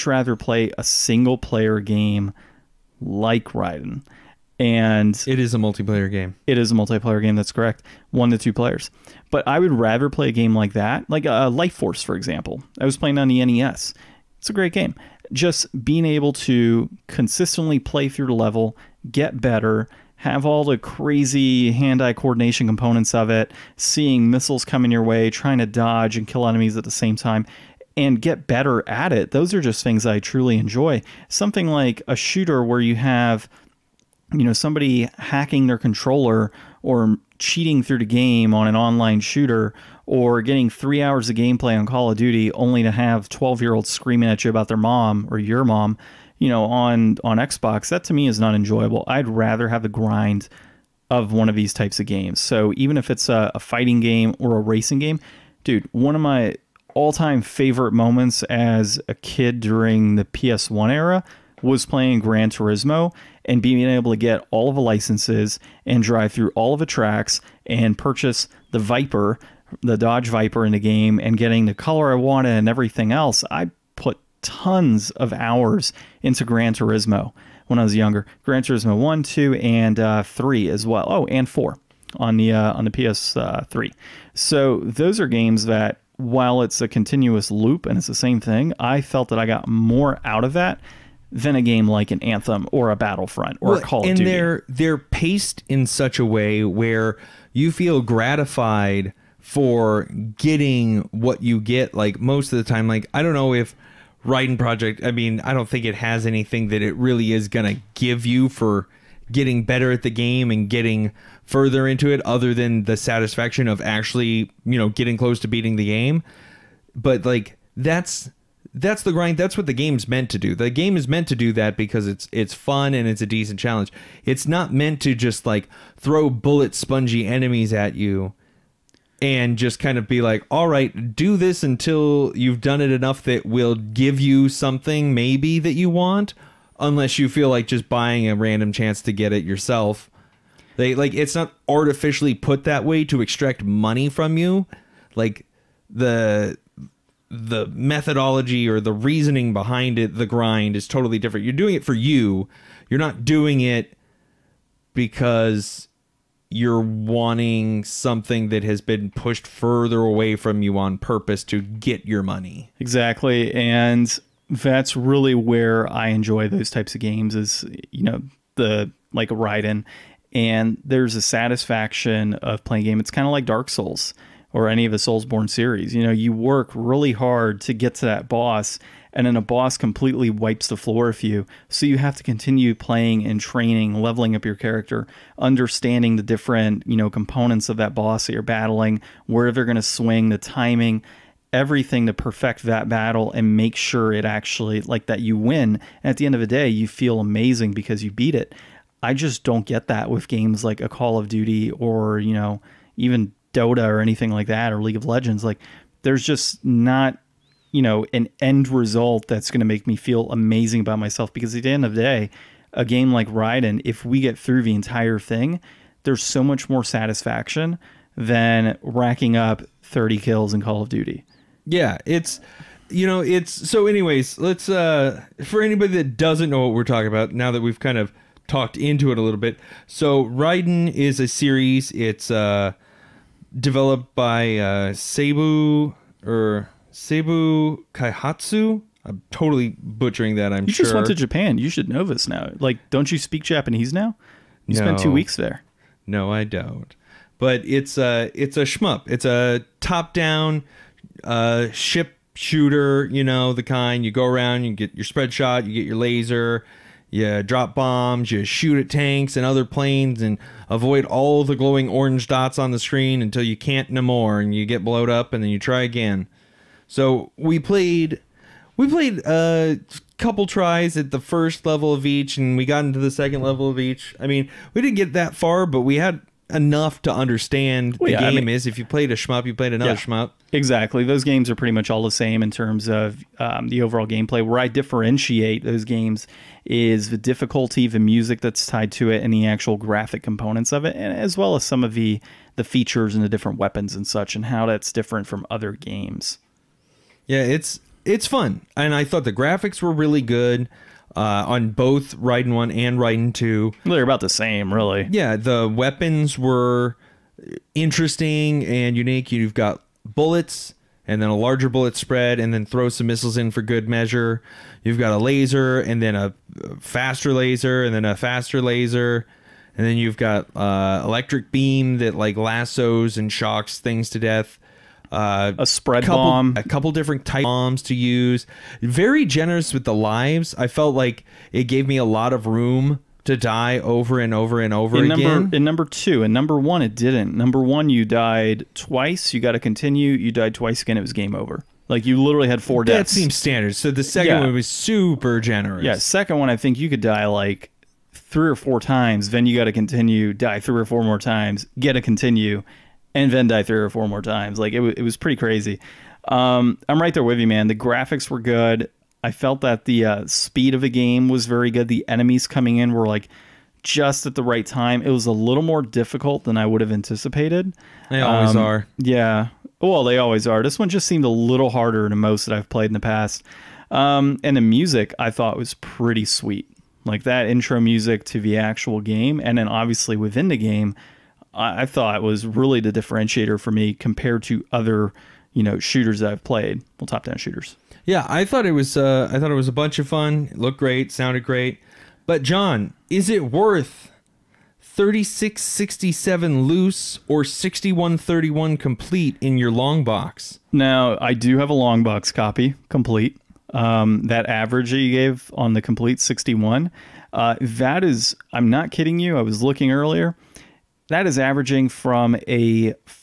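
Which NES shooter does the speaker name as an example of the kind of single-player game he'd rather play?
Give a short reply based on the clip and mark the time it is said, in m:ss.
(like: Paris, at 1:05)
Life Force, at 0:11.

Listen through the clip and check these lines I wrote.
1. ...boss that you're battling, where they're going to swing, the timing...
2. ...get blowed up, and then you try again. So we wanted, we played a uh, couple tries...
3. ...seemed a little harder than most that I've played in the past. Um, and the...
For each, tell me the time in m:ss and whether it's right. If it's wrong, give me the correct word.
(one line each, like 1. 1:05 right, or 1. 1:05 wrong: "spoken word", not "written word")
1. 3:07 right
2. 4:24 wrong: "played", not "wanted"
3. 6:11 right.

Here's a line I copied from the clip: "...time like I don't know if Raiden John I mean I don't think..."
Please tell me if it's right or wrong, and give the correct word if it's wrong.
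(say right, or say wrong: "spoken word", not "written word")
wrong: "Project", not "John".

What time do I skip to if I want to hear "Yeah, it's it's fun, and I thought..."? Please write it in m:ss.
4:57.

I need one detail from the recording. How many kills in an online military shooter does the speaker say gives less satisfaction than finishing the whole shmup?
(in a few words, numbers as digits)
30.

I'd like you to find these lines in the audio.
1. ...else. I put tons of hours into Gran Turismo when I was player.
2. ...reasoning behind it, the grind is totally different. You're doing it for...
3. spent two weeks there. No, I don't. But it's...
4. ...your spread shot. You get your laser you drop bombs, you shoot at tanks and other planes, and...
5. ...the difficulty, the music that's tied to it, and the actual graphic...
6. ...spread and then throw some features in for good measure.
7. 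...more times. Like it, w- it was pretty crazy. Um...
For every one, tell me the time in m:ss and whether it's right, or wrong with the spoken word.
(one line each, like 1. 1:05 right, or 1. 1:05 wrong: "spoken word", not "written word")
1. 1:13 wrong: "younger", not "player"
2. 2:28 right
3. 4:04 right
4. 4:14 right
5. 4:47 right
6. 5:11 wrong: "missiles", not "features"
7. 5:54 right.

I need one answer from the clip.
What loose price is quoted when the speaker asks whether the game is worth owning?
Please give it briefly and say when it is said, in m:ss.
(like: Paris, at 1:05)
$36.67, at 6:34.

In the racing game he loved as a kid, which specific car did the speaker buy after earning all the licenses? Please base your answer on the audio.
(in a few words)
Dodge Viper.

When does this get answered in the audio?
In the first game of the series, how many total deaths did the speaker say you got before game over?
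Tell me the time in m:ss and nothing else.
5:42.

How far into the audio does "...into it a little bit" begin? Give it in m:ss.
3:48.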